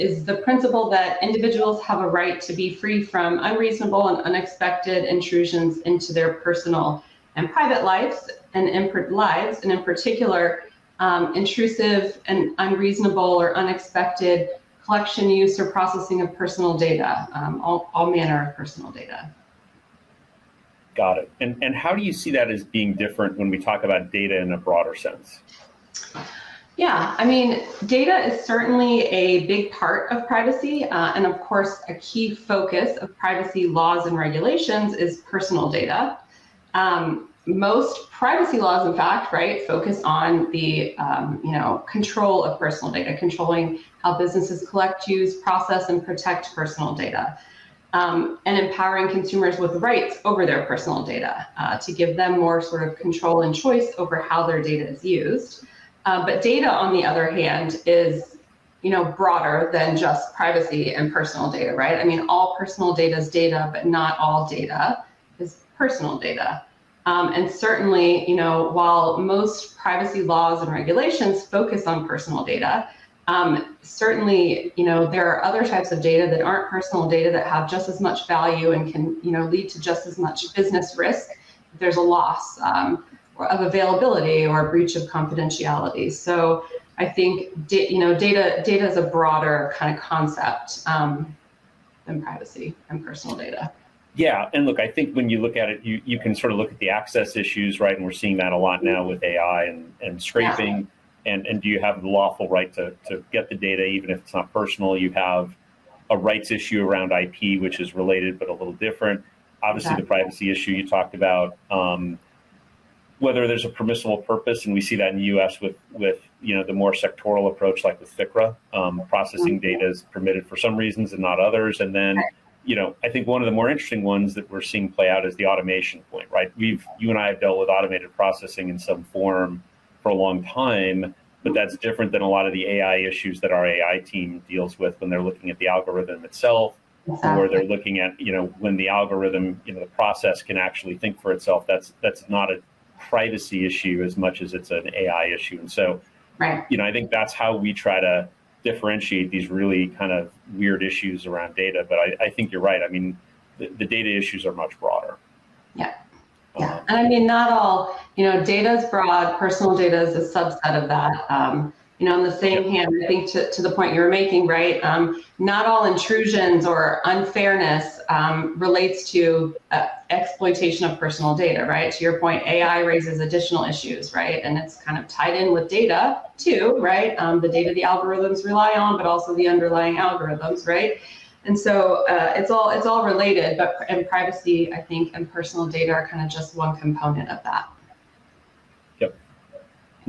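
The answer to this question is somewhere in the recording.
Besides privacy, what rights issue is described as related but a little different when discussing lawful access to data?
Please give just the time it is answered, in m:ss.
1:47.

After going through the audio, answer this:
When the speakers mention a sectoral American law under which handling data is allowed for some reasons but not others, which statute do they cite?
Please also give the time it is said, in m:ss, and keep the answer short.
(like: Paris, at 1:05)
FCRA, at 1:58.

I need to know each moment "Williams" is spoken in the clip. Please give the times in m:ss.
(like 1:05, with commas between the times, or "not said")
not said.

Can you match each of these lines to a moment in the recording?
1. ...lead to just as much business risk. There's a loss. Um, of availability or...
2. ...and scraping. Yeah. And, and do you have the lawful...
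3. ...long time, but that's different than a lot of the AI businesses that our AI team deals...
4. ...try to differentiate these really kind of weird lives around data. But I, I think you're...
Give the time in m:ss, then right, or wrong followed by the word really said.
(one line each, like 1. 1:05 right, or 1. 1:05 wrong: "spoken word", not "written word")
1. 1:19 right
2. 1:40 right
3. 2:10 wrong: "issues", not "businesses"
4. 2:27 wrong: "issues", not "lives".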